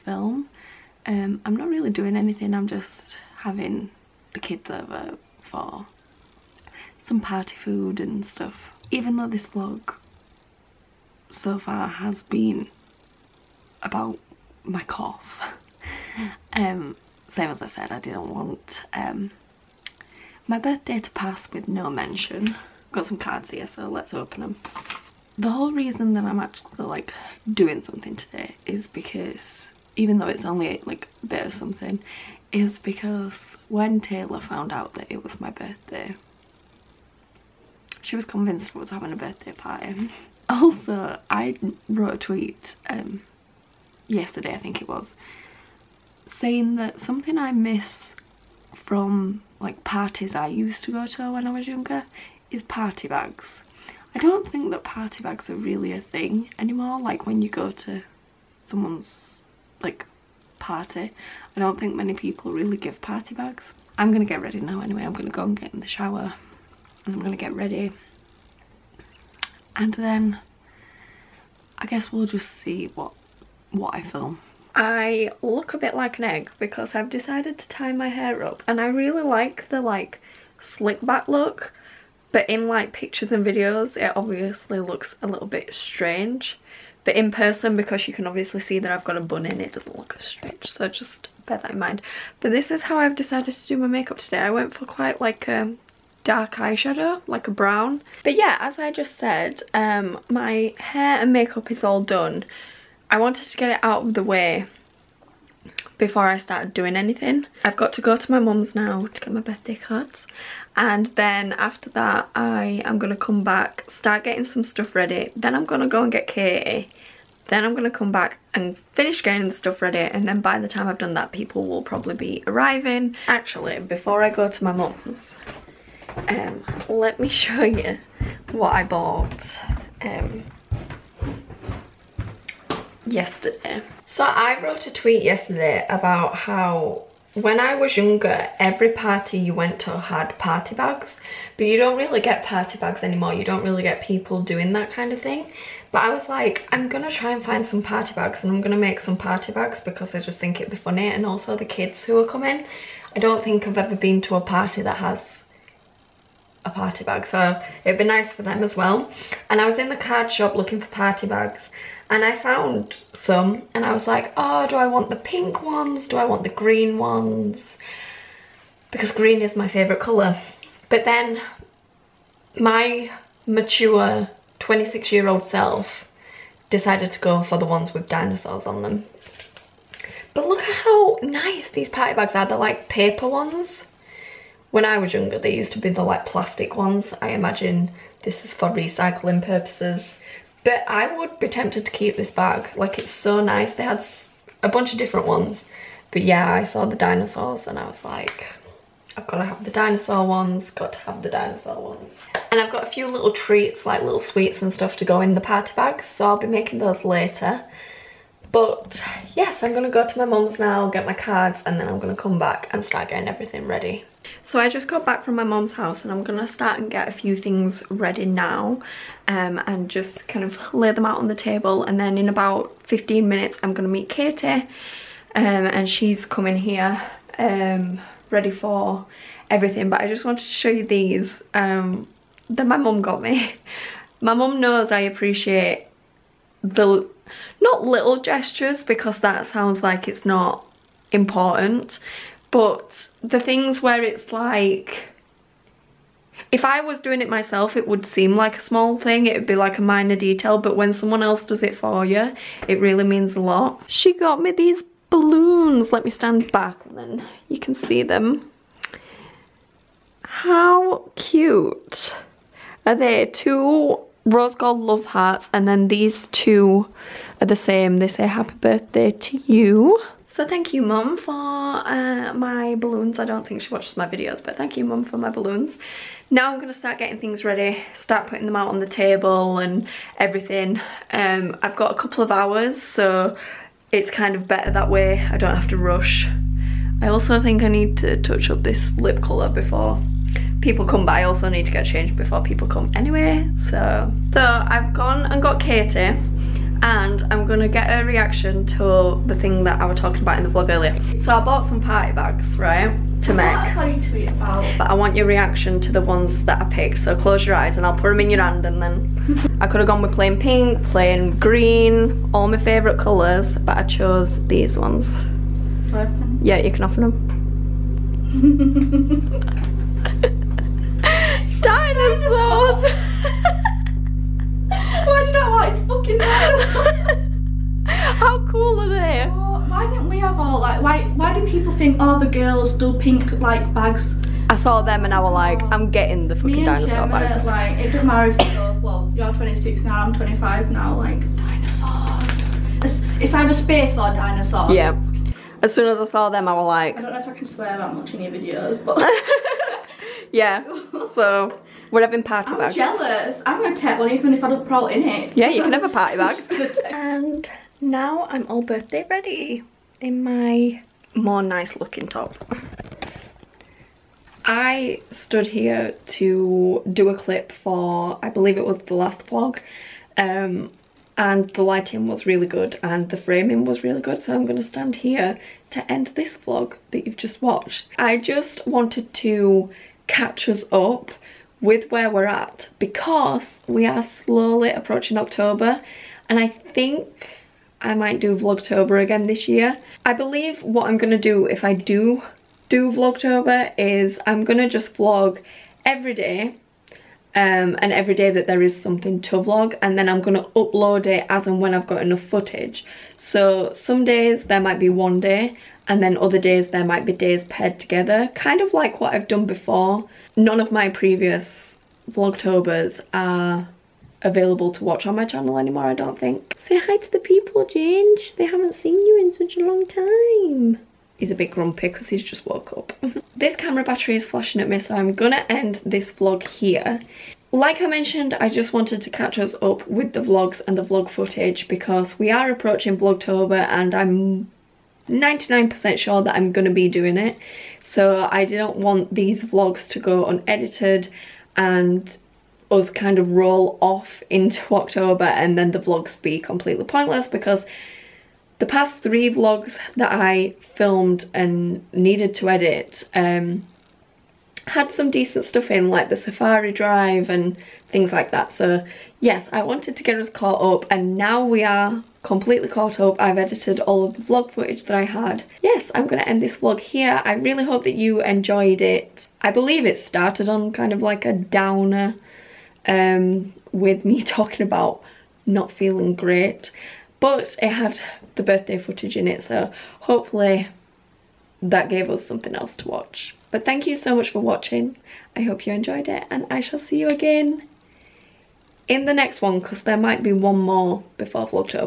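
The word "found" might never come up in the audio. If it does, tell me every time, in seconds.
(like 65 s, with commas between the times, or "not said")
34 s, 162 s.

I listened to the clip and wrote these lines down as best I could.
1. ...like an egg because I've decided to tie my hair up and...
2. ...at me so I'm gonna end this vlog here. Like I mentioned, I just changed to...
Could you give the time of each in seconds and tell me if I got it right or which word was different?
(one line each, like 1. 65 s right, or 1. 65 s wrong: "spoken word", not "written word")
1. 75 s right
2. 424 s wrong: "wanted", not "changed".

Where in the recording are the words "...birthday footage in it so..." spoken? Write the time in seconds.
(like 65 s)
478 s.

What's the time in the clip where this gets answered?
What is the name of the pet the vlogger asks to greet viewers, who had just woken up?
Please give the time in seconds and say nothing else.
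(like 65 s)
417 s.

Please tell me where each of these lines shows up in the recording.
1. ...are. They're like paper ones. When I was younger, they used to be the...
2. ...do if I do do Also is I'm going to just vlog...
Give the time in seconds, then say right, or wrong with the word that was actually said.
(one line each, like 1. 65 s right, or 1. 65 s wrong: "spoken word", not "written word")
1. 182 s right
2. 391 s wrong: "Vlogtober", not "Also".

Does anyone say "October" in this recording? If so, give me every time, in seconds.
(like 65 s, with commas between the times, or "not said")
385 s, 444 s.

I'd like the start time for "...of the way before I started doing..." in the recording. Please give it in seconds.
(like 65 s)
104 s.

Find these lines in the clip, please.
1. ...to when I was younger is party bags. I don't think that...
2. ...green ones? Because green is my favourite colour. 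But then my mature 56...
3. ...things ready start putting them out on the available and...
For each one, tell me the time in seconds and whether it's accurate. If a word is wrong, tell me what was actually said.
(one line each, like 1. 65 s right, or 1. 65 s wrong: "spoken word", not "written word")
1. 51 s right
2. 166 s wrong: "26", not "56"
3. 277 s wrong: "table", not "available".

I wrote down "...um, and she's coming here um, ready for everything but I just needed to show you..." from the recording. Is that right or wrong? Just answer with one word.
wrong.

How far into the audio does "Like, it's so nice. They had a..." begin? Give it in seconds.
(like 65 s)
192 s.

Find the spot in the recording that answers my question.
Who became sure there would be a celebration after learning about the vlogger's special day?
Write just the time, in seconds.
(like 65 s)
34 s.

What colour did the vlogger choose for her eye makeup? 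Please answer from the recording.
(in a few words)
brown.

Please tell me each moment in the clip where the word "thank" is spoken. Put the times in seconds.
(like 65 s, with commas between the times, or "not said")
270 s, 274 s, 483 s.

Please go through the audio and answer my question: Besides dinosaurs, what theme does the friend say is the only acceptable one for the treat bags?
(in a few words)
space.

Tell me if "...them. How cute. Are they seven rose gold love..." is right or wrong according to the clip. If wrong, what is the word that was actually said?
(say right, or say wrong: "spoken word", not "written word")
wrong: "two", not "seven".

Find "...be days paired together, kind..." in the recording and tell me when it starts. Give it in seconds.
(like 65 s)
407 s.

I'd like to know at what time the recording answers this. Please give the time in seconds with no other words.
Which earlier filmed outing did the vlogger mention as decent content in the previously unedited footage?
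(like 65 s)
456 s.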